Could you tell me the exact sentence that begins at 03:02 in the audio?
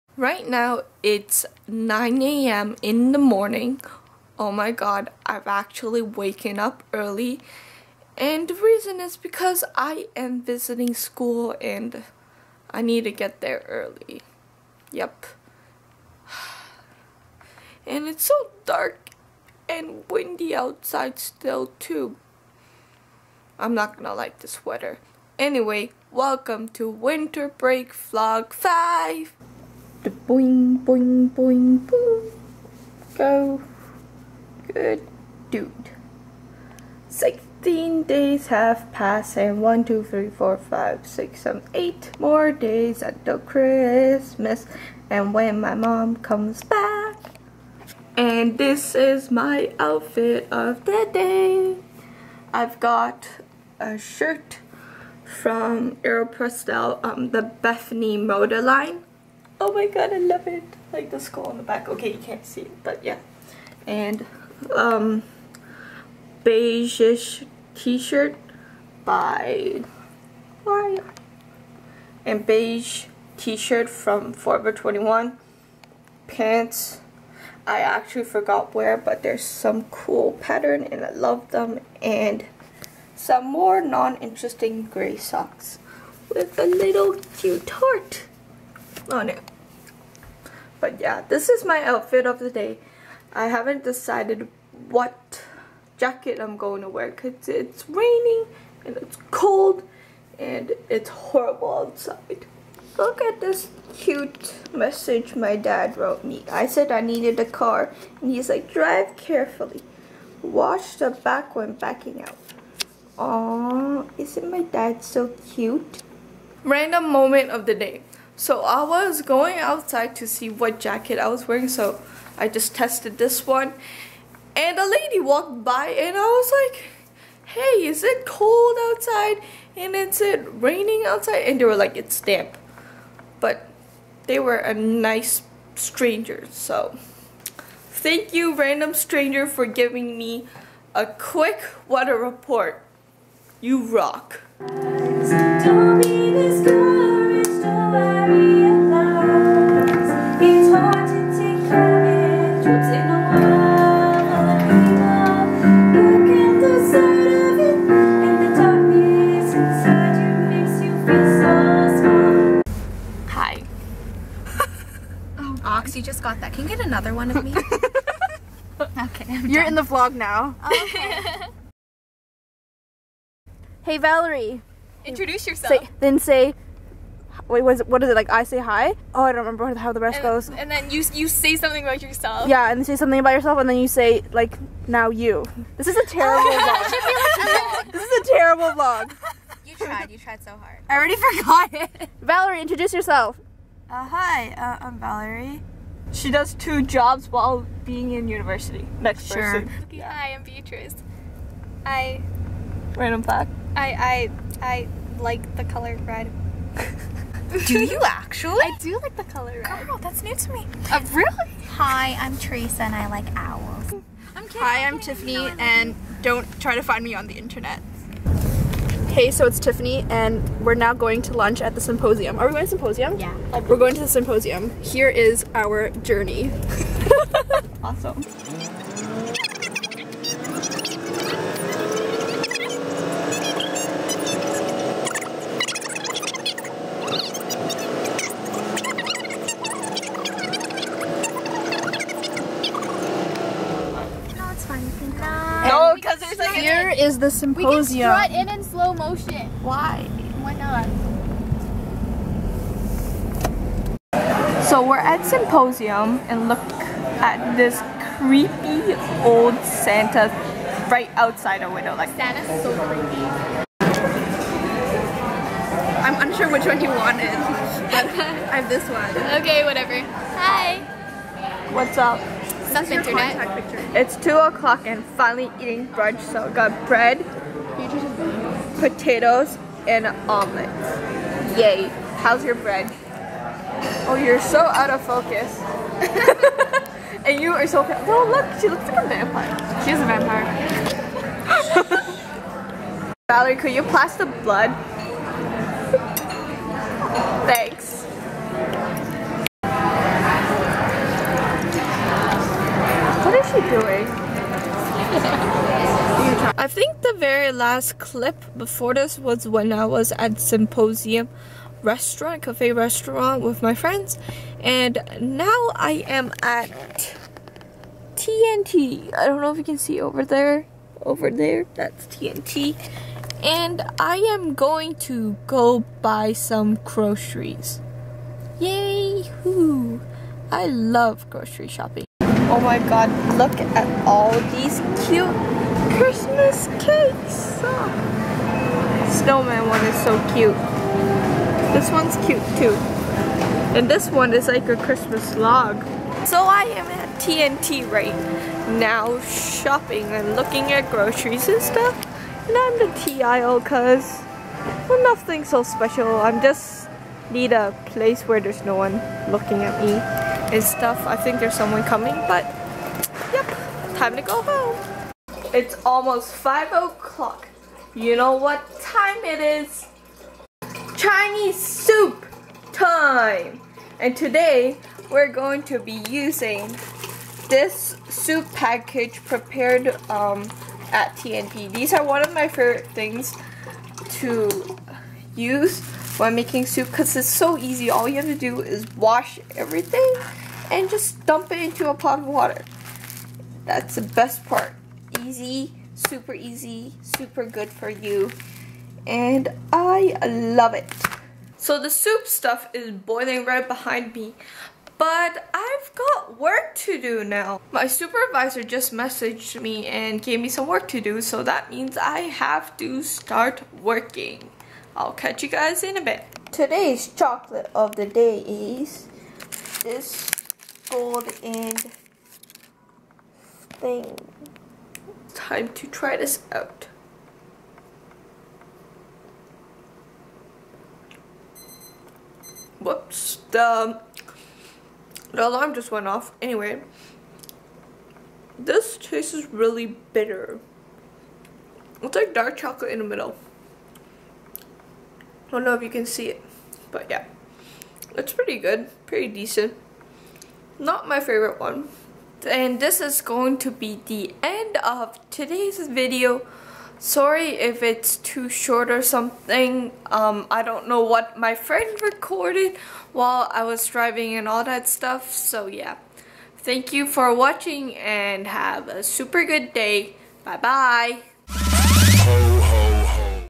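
Yeah, and say something about yourself, and then you say, like, now you.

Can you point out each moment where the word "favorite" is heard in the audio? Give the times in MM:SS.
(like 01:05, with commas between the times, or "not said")
06:22, 07:31.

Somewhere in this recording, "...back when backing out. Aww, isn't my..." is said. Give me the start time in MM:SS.
01:51.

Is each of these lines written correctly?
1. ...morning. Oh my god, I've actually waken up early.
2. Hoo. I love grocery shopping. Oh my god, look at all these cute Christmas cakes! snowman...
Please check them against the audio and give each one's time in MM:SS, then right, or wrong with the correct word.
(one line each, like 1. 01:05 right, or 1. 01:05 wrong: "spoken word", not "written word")
1. 00:03 right
2. 05:29 right.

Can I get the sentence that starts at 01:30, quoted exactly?
But yeah, this is my outfit of the day.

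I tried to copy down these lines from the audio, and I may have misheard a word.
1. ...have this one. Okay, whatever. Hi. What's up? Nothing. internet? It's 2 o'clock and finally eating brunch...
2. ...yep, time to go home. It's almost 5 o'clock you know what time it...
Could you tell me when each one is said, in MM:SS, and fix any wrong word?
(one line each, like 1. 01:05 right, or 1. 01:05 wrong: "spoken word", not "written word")
1. 04:28 right
2. 06:03 right.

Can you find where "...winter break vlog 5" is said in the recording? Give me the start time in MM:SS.
00:26.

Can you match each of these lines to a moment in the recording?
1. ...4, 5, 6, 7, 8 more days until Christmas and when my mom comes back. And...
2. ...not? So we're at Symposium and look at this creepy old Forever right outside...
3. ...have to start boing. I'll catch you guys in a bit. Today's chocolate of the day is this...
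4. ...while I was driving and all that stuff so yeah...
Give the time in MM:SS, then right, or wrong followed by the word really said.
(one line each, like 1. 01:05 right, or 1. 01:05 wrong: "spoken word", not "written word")
1. 00:40 right
2. 04:10 wrong: "Santa", not "Forever"
3. 06:52 wrong: "working", not "boing"
4. 07:43 right.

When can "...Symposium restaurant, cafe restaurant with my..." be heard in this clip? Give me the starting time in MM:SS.
05:10.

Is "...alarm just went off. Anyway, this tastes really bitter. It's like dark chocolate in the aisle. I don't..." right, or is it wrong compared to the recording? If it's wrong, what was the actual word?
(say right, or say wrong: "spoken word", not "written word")
wrong: "middle", not "aisle".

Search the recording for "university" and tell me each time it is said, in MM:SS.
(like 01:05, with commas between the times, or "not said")
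03:18.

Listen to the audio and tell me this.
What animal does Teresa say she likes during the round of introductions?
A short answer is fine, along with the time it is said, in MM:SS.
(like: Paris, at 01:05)
owls, at 03:33.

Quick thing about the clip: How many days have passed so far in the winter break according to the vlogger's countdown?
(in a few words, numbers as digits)
16.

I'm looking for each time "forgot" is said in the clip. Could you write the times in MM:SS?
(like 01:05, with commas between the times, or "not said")
01:18, 03:11.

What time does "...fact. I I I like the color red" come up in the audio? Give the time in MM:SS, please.
03:23.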